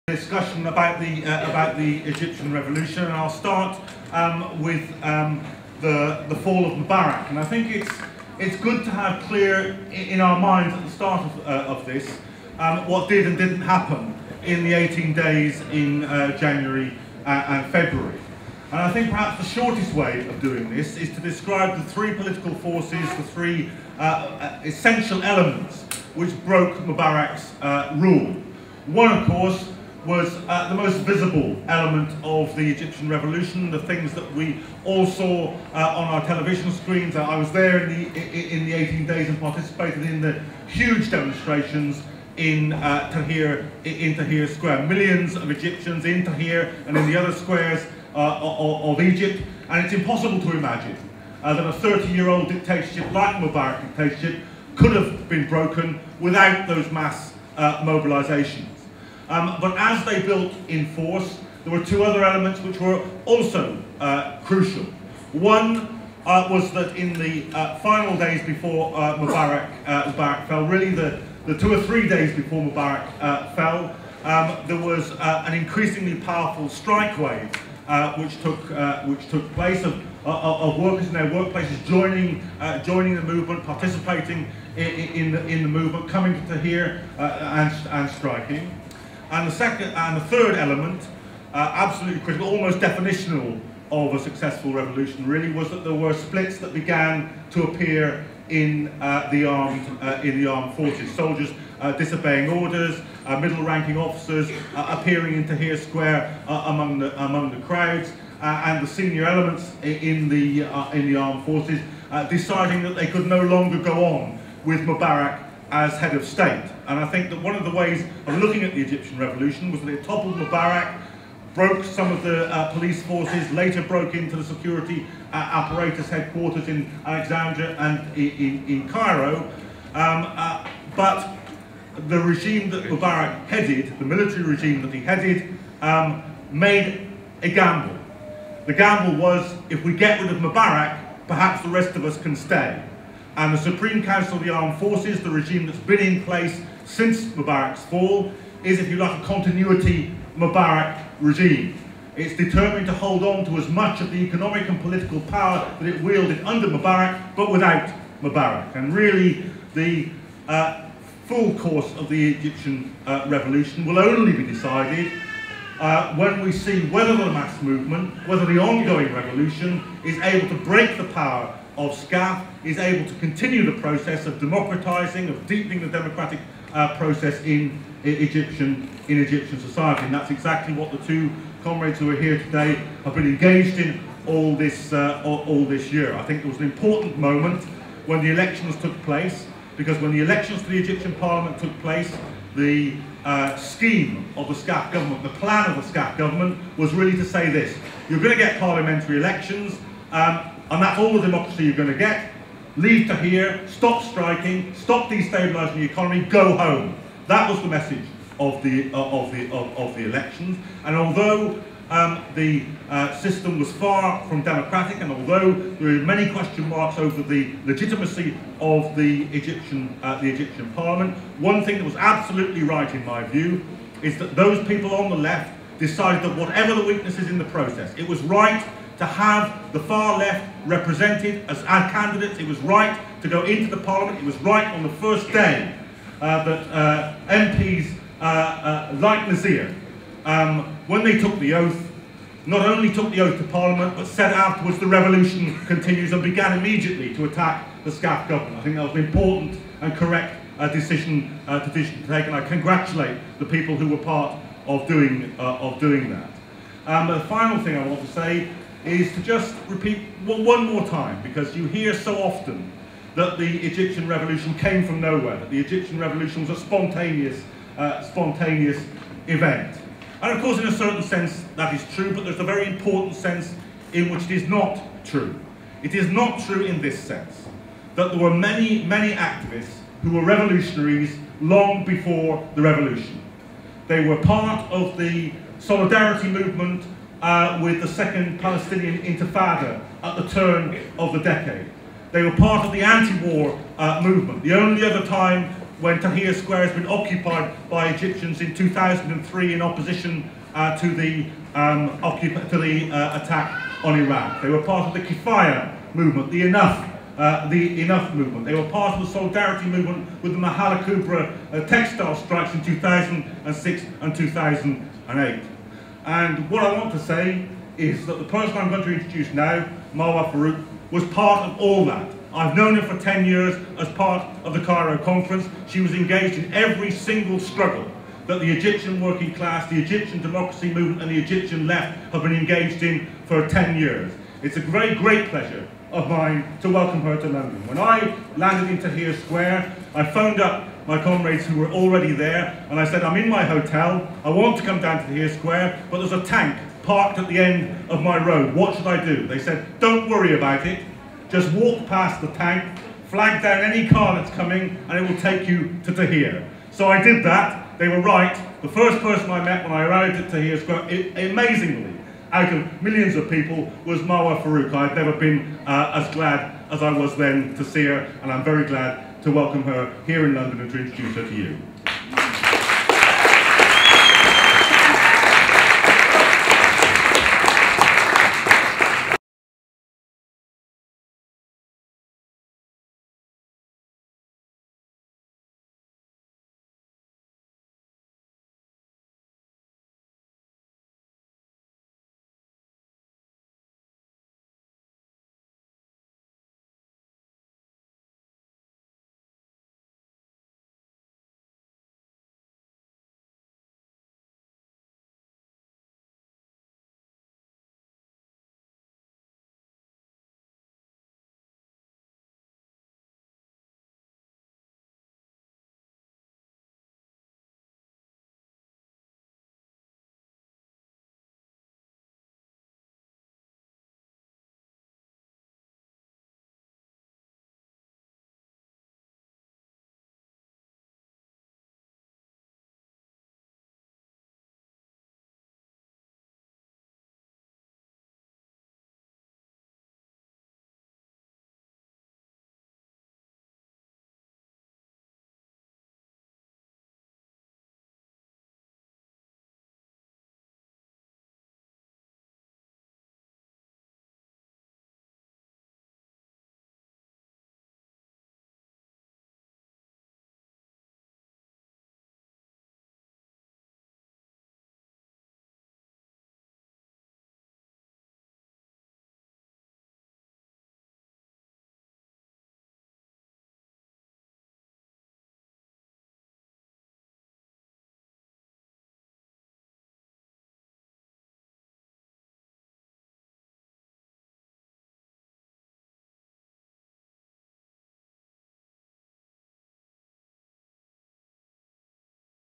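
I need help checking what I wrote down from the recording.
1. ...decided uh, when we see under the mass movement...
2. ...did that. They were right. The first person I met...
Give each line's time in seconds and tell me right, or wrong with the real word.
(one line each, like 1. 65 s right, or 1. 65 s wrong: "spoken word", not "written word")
1. 164 s wrong: "whether", not "under"
2. 357 s right.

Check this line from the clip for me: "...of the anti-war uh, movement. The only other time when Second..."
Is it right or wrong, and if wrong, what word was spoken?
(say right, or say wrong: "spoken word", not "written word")
wrong: "Tahrir", not "Second".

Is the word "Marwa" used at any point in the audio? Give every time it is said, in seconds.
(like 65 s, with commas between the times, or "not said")
319 s, 364 s.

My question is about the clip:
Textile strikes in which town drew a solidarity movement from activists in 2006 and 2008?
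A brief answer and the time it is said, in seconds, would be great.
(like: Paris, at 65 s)
Mahala Kubra, at 310 s.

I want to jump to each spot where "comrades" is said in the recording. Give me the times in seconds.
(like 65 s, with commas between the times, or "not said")
181 s, 341 s.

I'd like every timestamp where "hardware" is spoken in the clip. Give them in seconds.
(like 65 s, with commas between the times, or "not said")
not said.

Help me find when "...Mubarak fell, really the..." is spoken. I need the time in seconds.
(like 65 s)
70 s.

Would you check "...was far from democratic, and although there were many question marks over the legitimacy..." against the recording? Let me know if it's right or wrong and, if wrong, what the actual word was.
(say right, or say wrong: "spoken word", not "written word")
right.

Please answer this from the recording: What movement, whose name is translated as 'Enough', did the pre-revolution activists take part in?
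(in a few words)
Kifaya.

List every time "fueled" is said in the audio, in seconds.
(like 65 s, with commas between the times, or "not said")
not said.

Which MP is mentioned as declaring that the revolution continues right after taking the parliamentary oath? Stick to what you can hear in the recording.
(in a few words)
Nazir.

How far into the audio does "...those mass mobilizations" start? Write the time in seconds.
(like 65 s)
56 s.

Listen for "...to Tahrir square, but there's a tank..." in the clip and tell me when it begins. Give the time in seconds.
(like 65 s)
345 s.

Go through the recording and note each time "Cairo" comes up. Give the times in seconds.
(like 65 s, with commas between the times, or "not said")
128 s, 324 s.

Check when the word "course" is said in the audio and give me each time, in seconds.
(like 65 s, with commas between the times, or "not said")
29 s, 161 s, 270 s.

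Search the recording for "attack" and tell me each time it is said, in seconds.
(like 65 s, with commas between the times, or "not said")
247 s, 303 s.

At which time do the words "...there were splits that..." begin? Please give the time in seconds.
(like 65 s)
95 s.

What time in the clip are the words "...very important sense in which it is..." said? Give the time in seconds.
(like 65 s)
272 s.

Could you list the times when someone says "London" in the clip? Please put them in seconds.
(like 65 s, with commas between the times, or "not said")
337 s, 370 s.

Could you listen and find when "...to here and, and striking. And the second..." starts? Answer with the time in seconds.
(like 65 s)
86 s.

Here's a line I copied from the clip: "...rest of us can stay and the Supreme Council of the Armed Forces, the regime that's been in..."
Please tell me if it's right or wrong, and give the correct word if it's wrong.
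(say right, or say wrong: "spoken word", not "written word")
right.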